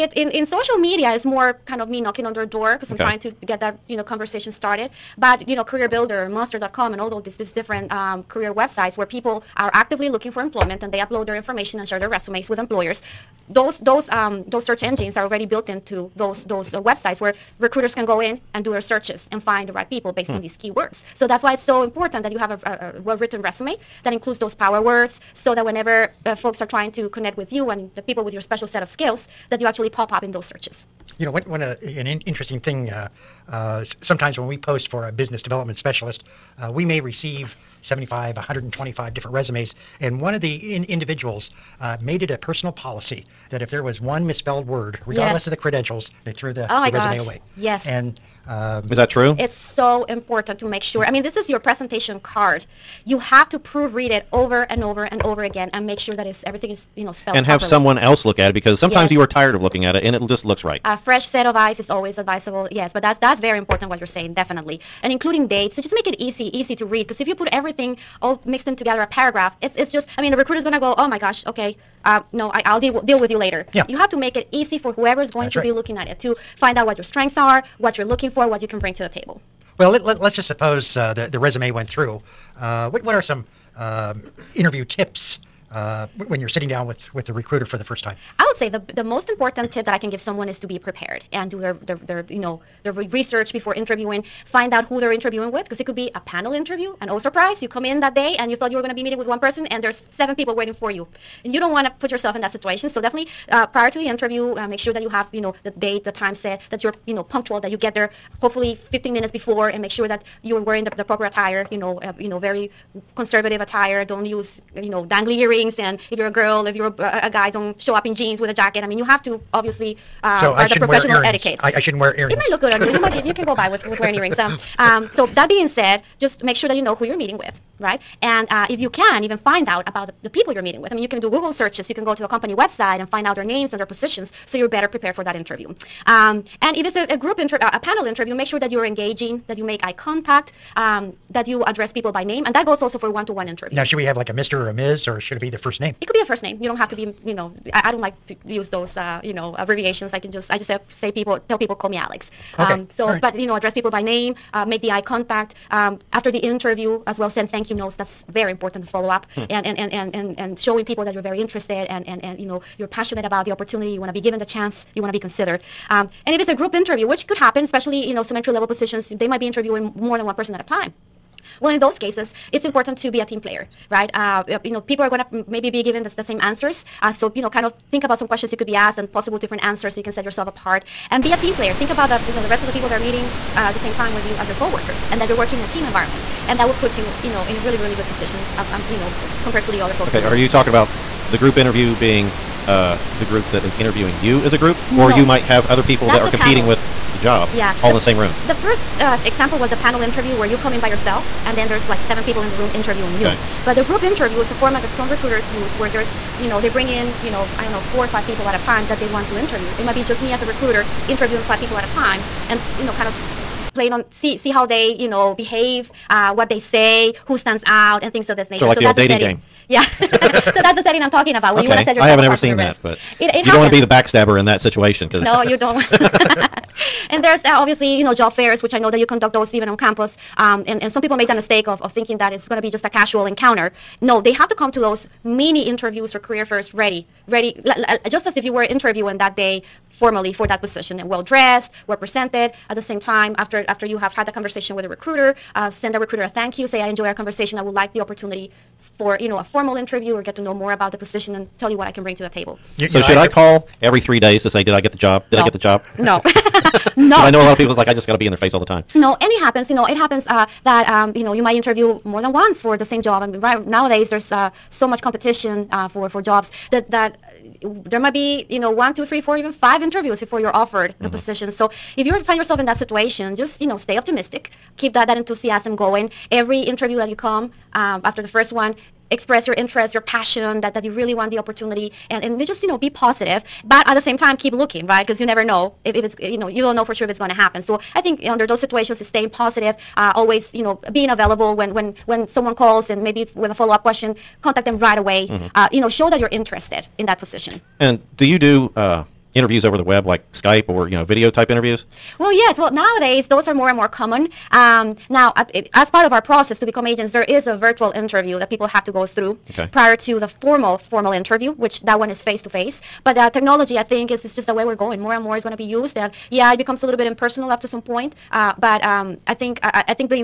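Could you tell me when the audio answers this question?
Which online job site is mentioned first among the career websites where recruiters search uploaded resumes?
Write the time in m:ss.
0:05.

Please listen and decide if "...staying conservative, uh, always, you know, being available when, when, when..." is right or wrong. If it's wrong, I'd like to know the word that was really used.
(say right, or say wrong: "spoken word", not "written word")
wrong: "positive", not "conservative".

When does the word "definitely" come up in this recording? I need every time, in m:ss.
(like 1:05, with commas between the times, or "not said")
1:04, 1:43.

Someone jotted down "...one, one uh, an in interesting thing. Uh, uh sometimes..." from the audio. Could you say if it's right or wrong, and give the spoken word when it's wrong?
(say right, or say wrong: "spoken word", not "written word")
right.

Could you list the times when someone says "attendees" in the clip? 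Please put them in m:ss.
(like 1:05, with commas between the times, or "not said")
not said.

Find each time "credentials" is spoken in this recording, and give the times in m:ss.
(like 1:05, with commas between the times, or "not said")
0:45.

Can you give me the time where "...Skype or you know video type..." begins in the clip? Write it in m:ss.
5:00.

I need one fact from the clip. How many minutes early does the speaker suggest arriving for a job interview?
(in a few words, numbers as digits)
15 minutes.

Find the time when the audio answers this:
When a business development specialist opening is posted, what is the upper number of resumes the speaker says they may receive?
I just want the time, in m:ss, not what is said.
0:38.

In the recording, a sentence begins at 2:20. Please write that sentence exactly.
Um, that you address people by name, and that goes also for one-to-one interviews.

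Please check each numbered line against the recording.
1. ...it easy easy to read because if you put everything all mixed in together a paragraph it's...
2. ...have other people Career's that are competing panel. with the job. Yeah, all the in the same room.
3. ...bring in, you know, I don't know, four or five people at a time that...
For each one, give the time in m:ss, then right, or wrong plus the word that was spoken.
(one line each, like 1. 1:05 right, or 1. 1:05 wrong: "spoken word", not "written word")
1. 1:06 right
2. 3:15 wrong: "That", not "Career"
3. 3:26 right.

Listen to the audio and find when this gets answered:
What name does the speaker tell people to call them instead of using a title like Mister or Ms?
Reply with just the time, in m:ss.
2:31.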